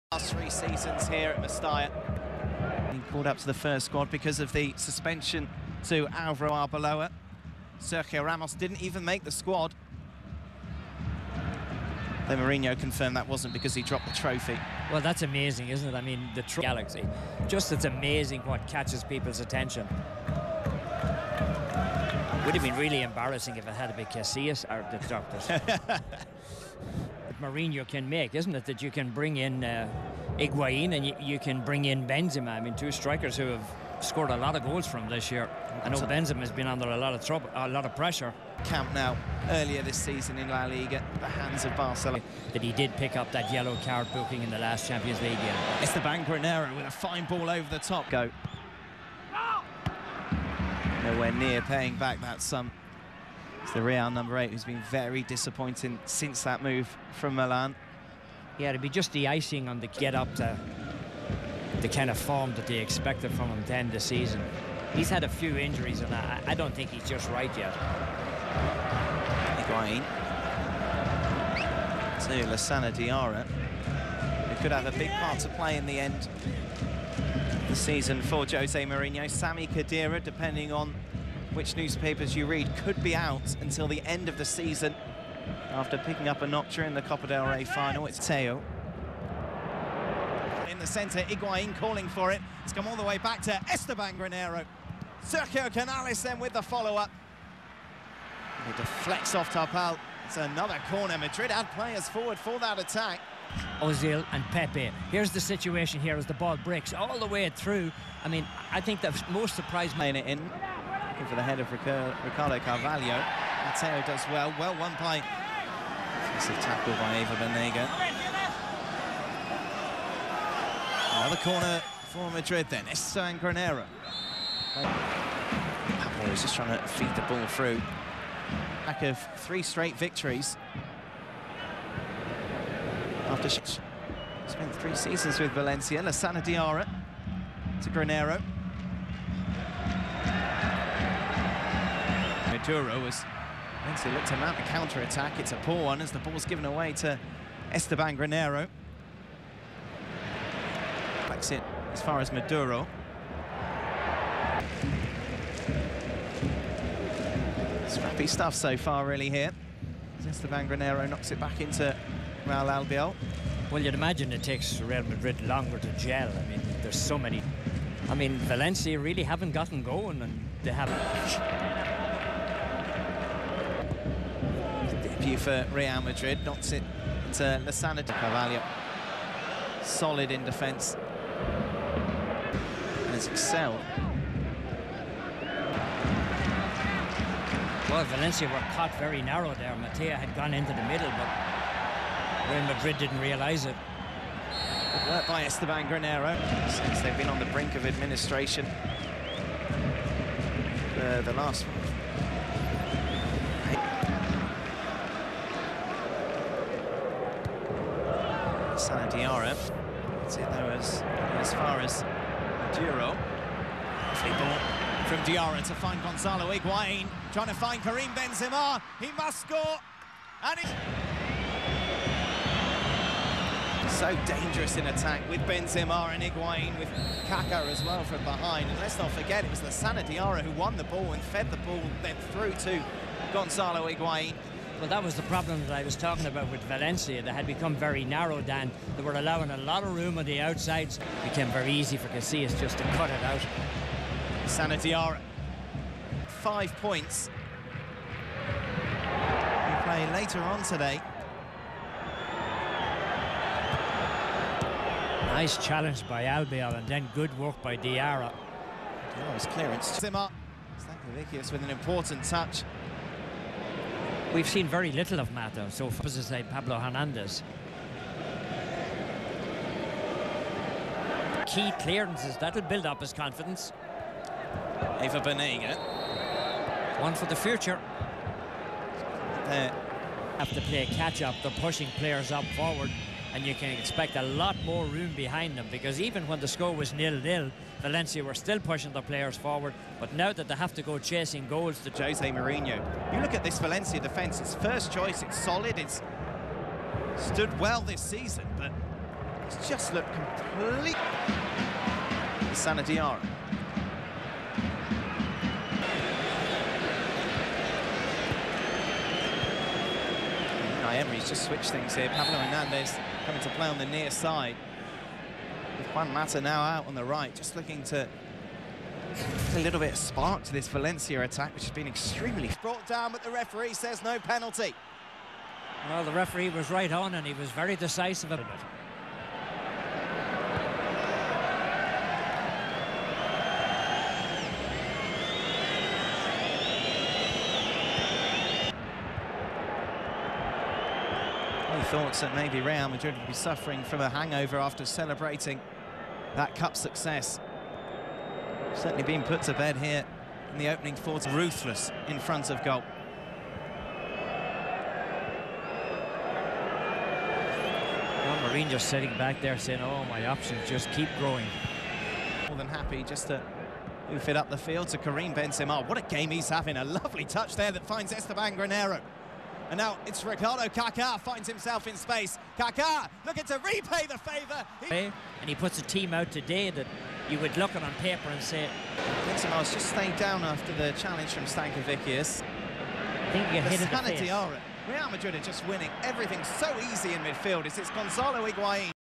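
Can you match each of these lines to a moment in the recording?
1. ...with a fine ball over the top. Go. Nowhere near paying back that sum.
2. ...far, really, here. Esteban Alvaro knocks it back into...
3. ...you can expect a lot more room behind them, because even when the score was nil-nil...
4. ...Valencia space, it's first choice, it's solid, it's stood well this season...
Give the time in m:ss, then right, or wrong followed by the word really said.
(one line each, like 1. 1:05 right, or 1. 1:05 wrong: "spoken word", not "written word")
1. 0:46 right
2. 2:38 wrong: "Granero", not "Alvaro"
3. 4:43 right
4. 4:53 wrong: "defence", not "space".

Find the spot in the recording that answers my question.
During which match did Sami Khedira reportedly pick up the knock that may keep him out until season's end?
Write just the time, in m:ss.
1:27.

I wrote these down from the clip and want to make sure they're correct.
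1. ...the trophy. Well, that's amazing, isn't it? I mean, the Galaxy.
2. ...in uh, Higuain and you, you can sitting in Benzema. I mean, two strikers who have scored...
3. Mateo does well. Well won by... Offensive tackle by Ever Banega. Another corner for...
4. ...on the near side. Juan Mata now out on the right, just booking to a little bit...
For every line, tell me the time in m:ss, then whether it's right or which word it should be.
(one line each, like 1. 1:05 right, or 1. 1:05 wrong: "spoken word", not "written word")
1. 0:14 right
2. 0:29 wrong: "bring", not "sitting"
3. 1:53 right
4. 5:13 wrong: "looking", not "booking".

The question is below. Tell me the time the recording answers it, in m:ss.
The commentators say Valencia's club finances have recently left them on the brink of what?
3:17.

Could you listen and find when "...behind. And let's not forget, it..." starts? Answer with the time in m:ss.
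3:48.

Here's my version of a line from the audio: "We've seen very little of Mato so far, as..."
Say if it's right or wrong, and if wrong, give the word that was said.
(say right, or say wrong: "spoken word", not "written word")
right.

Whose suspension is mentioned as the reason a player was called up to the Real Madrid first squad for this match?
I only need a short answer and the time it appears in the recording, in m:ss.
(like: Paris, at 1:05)
Alvaro Arbeloa, at 0:06.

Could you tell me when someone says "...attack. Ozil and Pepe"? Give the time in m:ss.
1:42.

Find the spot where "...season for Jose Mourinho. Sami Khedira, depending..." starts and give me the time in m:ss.
1:17.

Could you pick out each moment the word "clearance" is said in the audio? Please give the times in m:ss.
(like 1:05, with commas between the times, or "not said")
4:19, 4:31.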